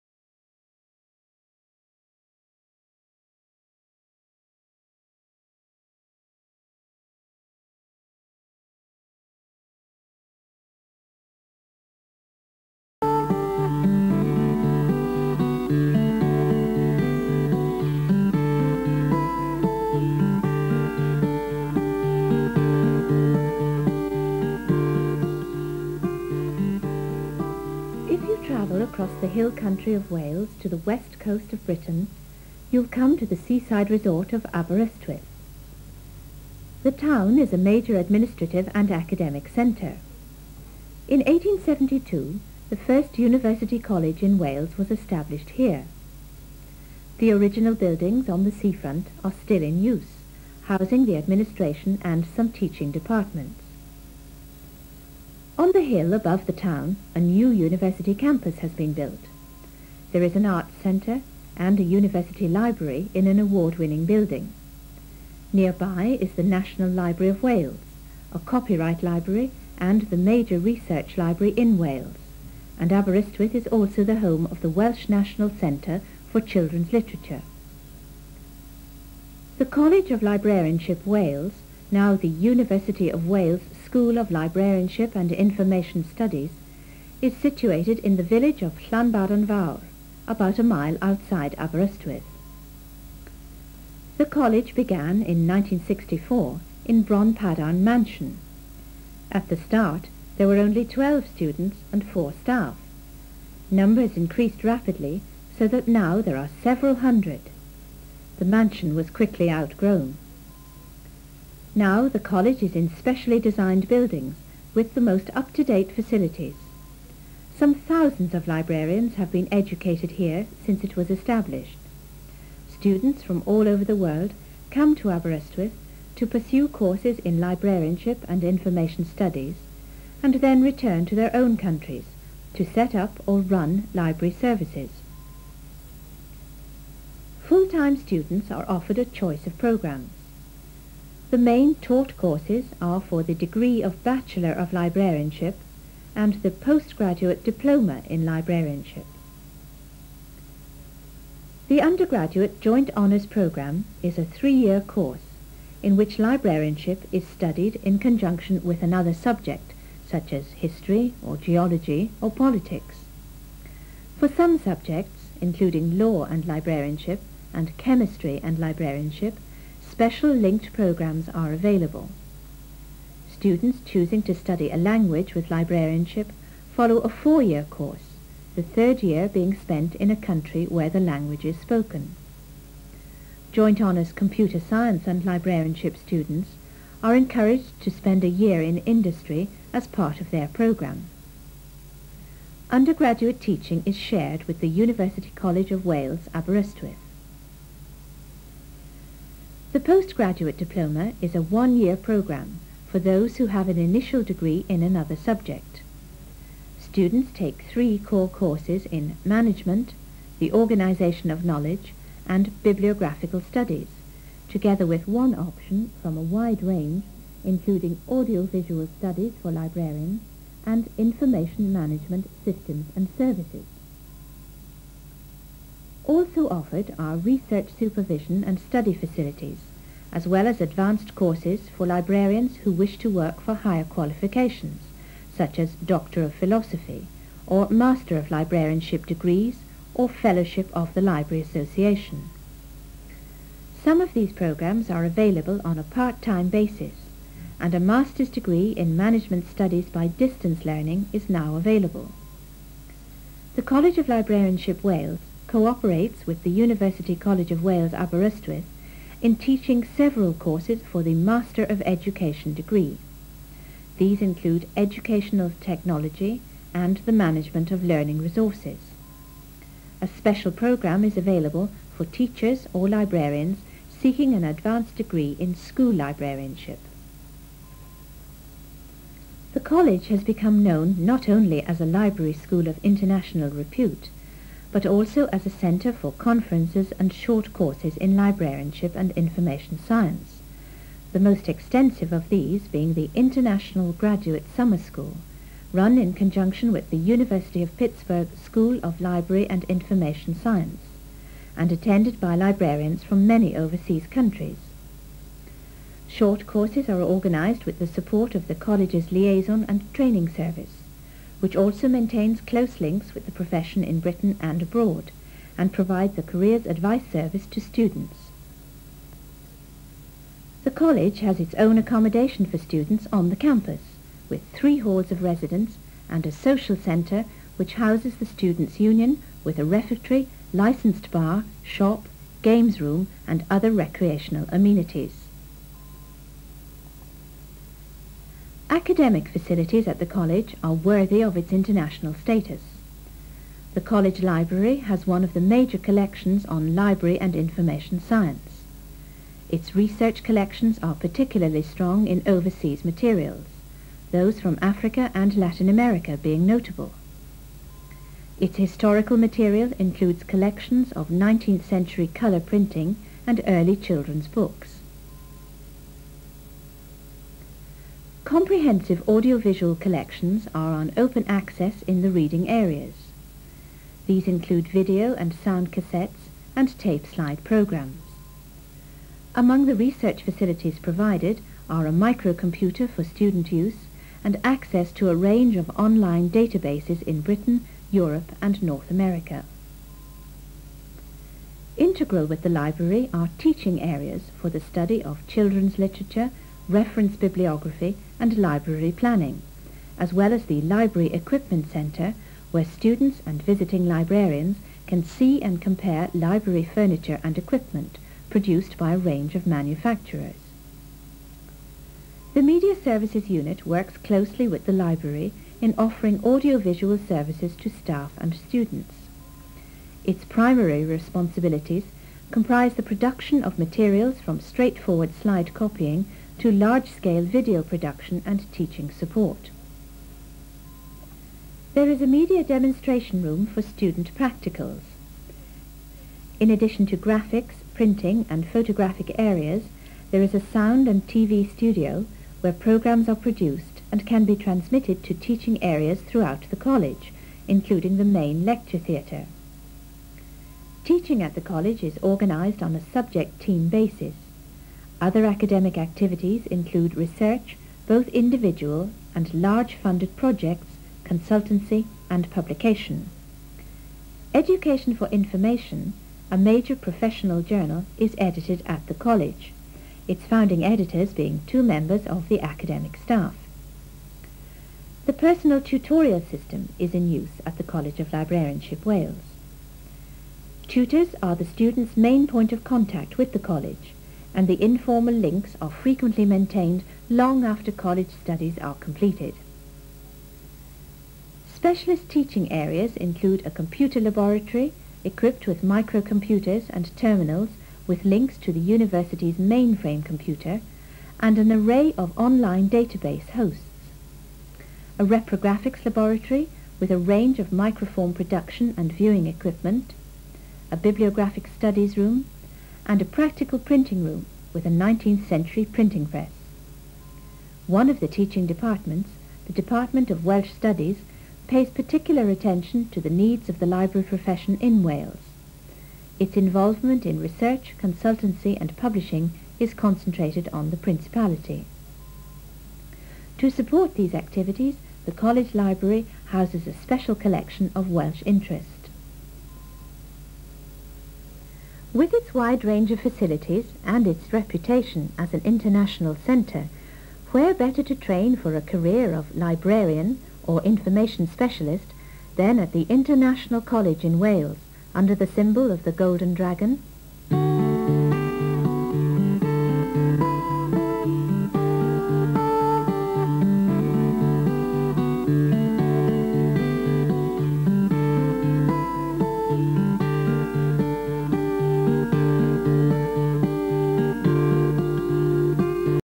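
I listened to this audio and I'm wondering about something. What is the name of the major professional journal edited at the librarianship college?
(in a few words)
Education for Information.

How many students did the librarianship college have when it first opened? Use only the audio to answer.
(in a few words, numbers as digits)
12.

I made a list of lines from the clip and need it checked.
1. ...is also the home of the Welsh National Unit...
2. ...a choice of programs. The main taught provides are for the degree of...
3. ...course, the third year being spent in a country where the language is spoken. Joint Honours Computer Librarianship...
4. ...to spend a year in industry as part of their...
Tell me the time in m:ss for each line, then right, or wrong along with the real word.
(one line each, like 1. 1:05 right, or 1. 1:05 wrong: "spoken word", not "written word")
1. 1:13 wrong: "Centre", not "Unit"
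2. 2:18 wrong: "courses", not "provides"
3. 2:57 wrong: "Science", not "Librarianship"
4. 3:07 right.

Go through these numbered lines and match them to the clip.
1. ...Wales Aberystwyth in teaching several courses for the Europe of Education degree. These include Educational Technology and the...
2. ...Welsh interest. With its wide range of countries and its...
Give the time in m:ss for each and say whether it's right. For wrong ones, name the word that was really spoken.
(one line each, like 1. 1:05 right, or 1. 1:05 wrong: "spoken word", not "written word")
1. 4:17 wrong: "Master", not "Europe"
2. 8:57 wrong: "facilities", not "countries".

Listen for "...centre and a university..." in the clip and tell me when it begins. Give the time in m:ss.
1:00.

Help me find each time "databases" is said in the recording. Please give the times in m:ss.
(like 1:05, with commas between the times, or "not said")
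6:26, 8:22.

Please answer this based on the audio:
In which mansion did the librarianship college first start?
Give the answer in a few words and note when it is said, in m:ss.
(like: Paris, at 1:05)
Bronpadarn Mansion, at 1:37.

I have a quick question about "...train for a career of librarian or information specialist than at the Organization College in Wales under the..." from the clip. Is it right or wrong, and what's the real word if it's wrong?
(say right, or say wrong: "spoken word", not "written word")
wrong: "International", not "Organization".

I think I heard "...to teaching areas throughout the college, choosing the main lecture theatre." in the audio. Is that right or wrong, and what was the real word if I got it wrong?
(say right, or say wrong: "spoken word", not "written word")
wrong: "including", not "choosing".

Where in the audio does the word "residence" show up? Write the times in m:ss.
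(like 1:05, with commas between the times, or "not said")
5:25.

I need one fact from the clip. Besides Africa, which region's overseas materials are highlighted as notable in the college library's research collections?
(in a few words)
Latin America.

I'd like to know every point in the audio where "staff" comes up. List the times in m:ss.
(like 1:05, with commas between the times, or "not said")
1:42, 6:57, 7:52.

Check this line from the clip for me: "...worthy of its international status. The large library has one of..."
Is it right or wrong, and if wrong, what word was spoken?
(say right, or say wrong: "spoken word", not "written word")
wrong: "college", not "large".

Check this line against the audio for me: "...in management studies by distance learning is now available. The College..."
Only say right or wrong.
right.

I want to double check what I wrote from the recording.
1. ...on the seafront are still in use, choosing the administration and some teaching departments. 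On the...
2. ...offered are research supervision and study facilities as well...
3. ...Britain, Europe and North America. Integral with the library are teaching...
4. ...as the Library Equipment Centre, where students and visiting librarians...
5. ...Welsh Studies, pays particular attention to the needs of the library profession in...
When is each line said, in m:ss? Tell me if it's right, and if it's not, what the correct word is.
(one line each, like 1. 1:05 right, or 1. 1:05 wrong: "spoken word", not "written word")
1. 0:48 wrong: "housing", not "choosing"
2. 3:46 right
3. 6:27 right
4. 6:40 right
5. 8:40 right.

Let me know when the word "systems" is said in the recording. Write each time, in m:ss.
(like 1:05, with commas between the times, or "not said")
3:42, 7:56.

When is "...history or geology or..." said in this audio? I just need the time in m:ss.
2:40.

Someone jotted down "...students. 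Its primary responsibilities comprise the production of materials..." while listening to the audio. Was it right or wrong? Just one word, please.
right.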